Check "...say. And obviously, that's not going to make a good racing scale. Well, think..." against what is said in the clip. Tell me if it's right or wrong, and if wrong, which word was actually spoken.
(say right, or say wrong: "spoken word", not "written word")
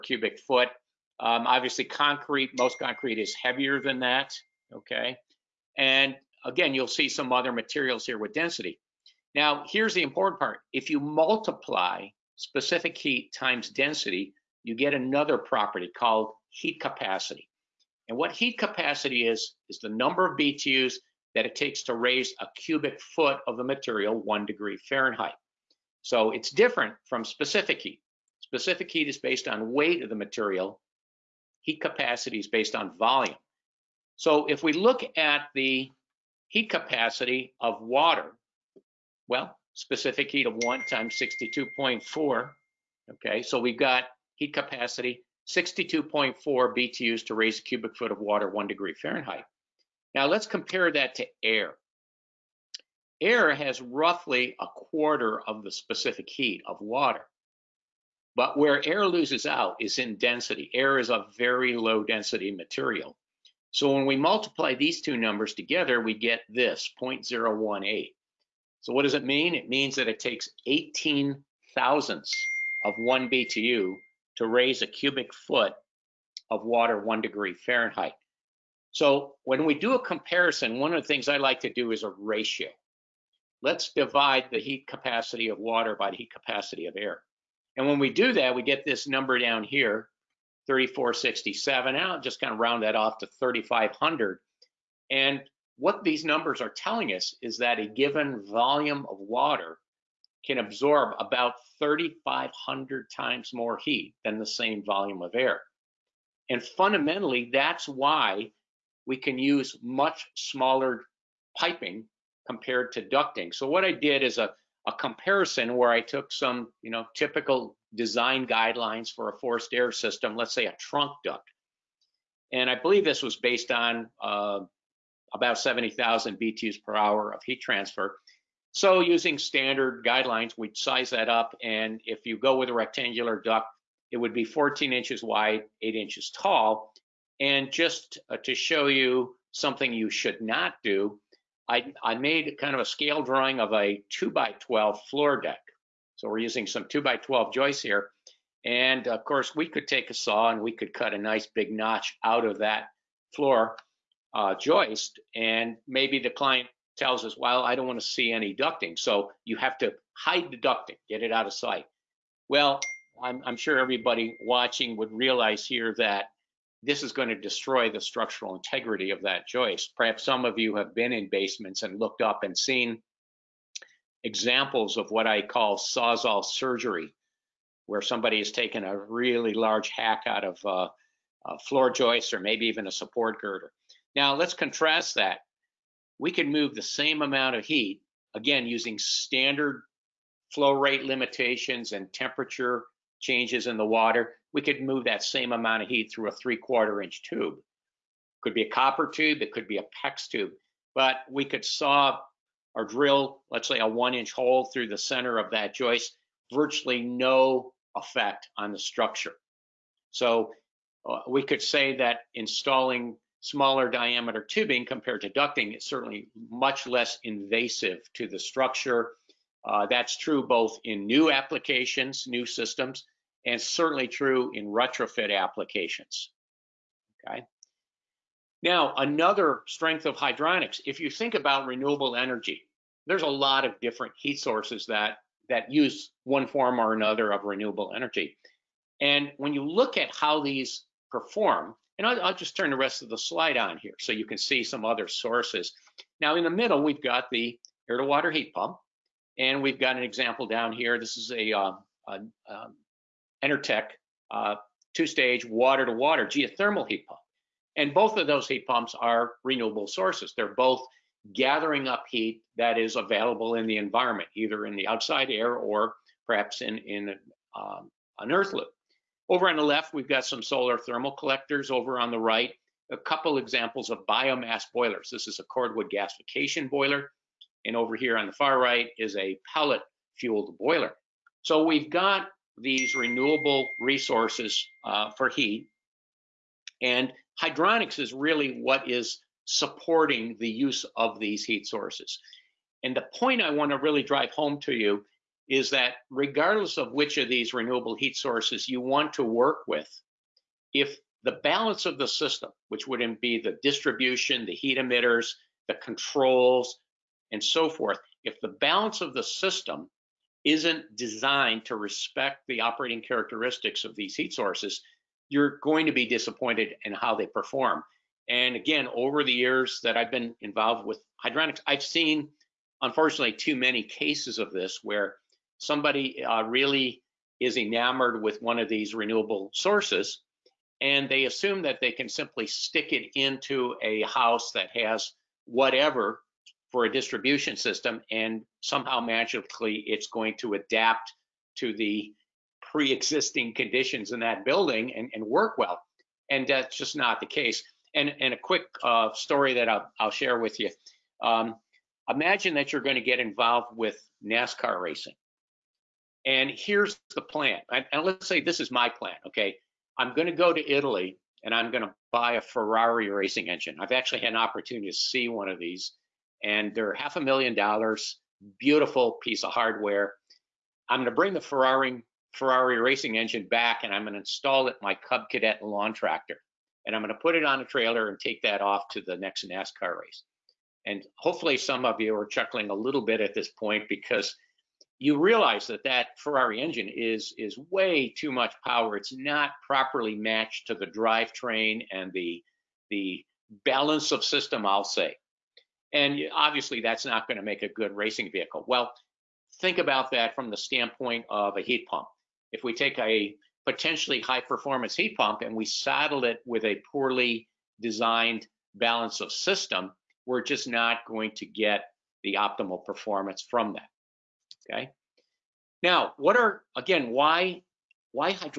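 wrong: "vehicle", not "scale".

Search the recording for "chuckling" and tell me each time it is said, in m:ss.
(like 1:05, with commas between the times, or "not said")
6:22.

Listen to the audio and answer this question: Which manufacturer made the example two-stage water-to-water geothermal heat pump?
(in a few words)
Enertech.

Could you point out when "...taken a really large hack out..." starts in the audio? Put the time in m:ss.
2:58.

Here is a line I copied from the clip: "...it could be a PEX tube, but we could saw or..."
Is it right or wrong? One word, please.
right.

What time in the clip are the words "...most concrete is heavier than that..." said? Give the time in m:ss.
0:02.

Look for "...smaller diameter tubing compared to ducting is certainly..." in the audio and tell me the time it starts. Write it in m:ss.
3:33.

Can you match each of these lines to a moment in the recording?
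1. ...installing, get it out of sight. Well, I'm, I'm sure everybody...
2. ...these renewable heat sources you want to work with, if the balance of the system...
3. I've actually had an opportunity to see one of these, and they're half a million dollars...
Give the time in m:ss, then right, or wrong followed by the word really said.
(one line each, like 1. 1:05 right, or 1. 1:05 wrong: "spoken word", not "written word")
1. 2:40 wrong: "ducting", not "installing"
2. 4:57 right
3. 6:03 right.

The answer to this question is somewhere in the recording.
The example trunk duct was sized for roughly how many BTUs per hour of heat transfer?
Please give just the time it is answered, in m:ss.
2:05.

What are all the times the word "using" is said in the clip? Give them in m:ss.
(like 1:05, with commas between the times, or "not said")
2:08, 2:26, 3:08.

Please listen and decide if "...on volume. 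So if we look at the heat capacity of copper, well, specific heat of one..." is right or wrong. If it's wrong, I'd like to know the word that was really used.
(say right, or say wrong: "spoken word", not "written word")
wrong: "water", not "copper".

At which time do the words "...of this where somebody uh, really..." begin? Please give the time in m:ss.
5:24.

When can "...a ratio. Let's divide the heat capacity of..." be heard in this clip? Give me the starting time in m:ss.
1:22.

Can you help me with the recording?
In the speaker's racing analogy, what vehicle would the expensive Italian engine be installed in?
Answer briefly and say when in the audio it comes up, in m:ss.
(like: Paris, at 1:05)
Cub Cadet lawn tractor, at 6:15.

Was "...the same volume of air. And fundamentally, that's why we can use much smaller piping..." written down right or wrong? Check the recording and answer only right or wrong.
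right.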